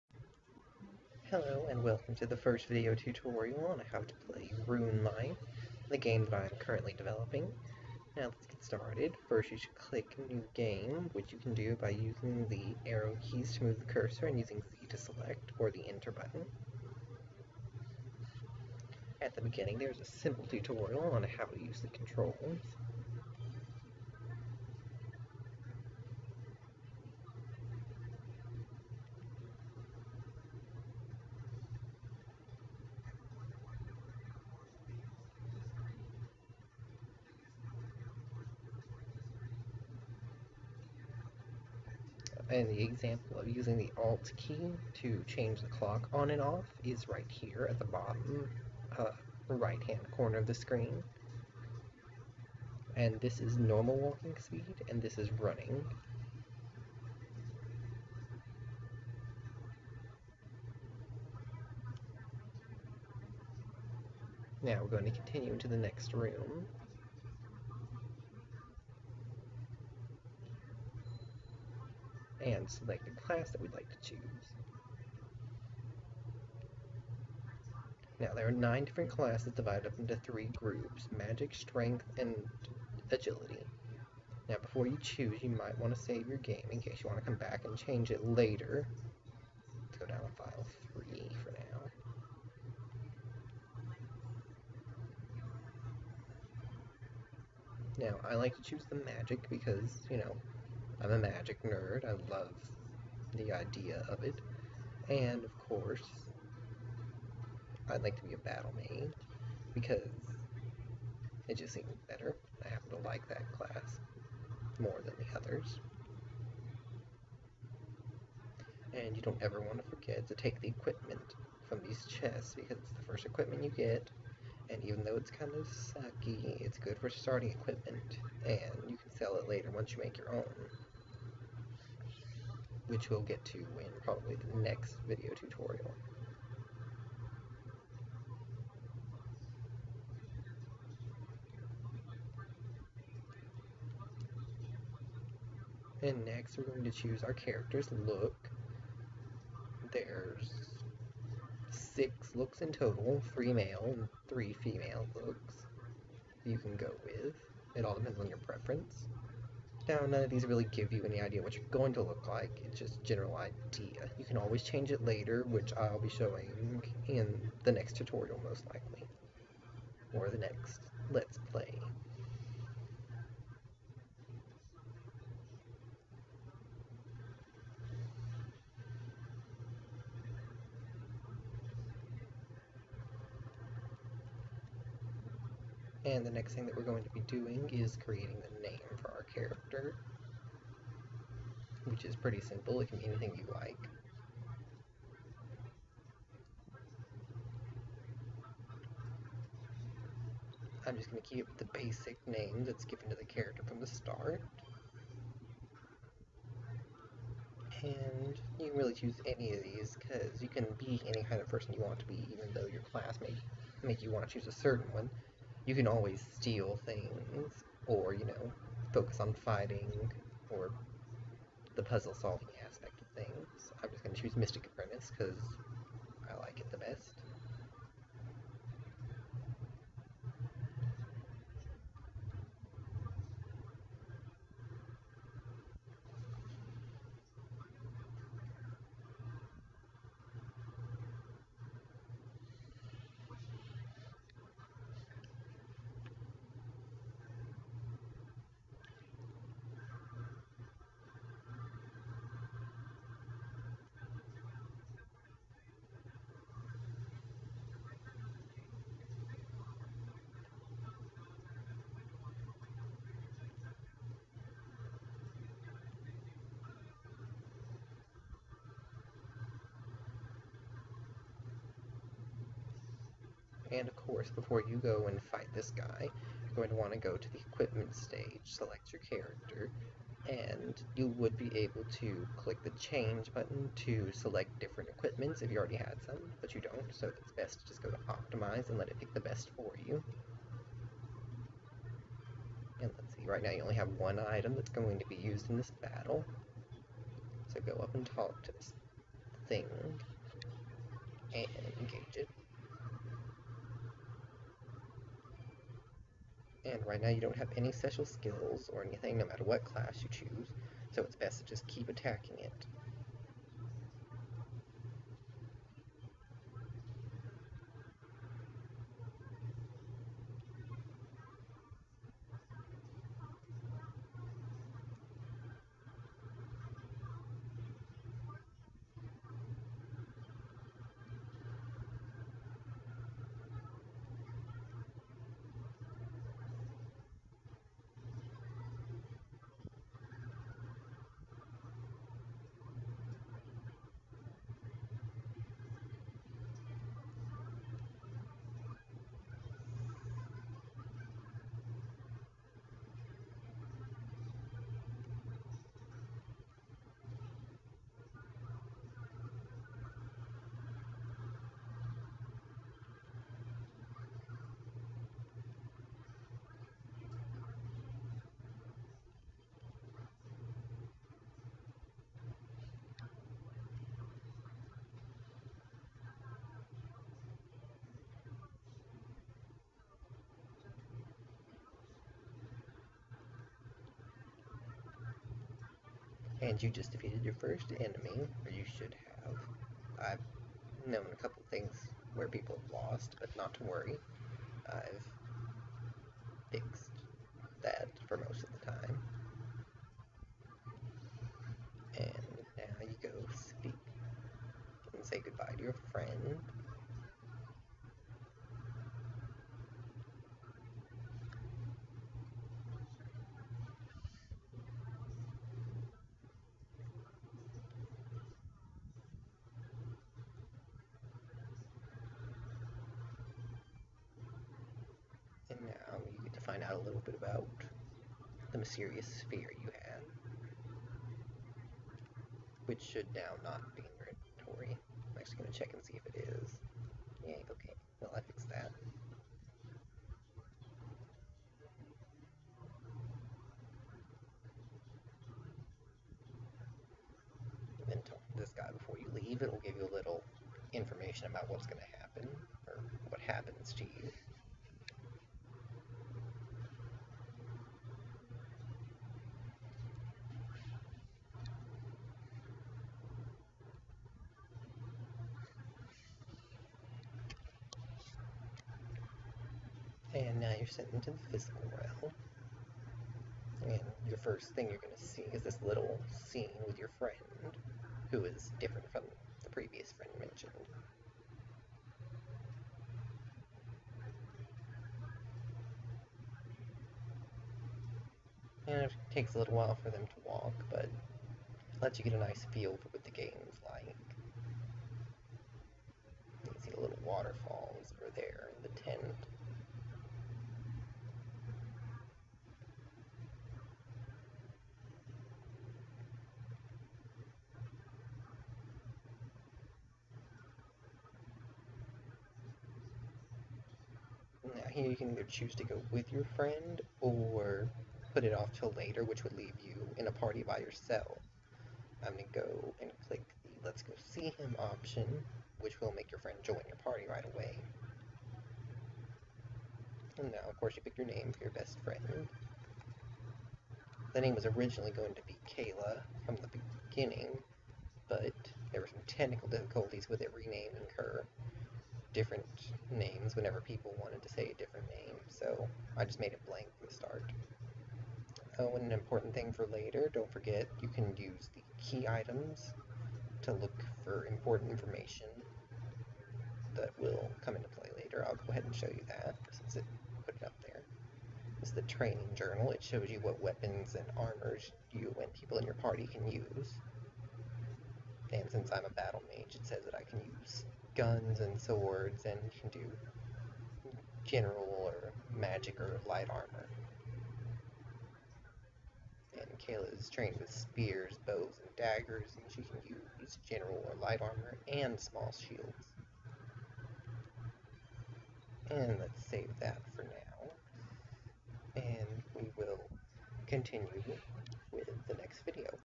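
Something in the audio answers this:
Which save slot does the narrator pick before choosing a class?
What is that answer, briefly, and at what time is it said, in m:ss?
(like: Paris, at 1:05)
File 3, at 1:30.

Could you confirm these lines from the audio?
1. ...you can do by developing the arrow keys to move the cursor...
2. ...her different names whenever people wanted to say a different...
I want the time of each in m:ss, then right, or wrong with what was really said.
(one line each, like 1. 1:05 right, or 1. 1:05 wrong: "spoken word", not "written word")
1. 0:11 wrong: "using", not "developing"
2. 9:00 right.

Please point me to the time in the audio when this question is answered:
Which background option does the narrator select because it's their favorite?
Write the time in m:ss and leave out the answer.
3:44.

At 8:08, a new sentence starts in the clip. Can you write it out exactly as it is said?
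And it takes a little while for them to walk, but lets you get a nice feel for what the game's like.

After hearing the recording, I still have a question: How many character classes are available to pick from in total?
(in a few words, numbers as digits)
9.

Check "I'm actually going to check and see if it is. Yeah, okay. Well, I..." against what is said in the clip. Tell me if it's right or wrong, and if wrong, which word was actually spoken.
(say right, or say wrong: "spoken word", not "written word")
right.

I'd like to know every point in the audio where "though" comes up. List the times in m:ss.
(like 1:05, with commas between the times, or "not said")
2:05, 3:32.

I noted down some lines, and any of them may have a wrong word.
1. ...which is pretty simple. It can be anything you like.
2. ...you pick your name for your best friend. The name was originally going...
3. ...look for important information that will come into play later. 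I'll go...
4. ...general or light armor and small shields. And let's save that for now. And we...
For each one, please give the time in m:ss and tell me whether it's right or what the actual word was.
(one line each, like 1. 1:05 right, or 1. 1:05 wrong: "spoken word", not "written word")
1. 3:11 right
2. 8:50 right
3. 9:13 right
4. 9:43 right.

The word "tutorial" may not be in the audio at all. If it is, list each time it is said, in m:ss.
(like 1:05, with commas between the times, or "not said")
0:02, 0:20, 2:15, 2:47.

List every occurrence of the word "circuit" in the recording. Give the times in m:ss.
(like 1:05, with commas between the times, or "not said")
not said.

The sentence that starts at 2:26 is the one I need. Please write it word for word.
And next we're going to choose our character's look.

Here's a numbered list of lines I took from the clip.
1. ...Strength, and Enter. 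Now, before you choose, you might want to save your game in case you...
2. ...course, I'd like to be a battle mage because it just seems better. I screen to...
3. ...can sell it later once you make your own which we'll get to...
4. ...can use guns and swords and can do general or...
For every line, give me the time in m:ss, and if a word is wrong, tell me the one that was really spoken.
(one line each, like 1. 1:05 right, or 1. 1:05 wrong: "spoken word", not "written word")
1. 1:21 wrong: "Agility", not "Enter"
2. 1:45 wrong: "happen", not "screen"
3. 2:08 right
4. 9:30 right.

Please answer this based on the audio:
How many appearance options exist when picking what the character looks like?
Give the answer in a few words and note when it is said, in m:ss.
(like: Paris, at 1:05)
6, at 2:31.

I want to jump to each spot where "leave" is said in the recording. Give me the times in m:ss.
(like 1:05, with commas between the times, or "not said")
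7:29, 8:39.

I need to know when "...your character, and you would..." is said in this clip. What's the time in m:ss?
4:38.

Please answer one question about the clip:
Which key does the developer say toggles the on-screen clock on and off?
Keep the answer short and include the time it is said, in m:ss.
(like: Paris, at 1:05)
Alt, at 0:43.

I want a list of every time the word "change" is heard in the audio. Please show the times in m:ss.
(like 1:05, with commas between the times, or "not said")
0:45, 1:27, 2:44, 4:42.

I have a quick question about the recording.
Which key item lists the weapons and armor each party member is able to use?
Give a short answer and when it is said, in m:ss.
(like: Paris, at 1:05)
Training journal, at 9:21.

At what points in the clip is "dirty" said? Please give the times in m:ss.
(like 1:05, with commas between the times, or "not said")
not said.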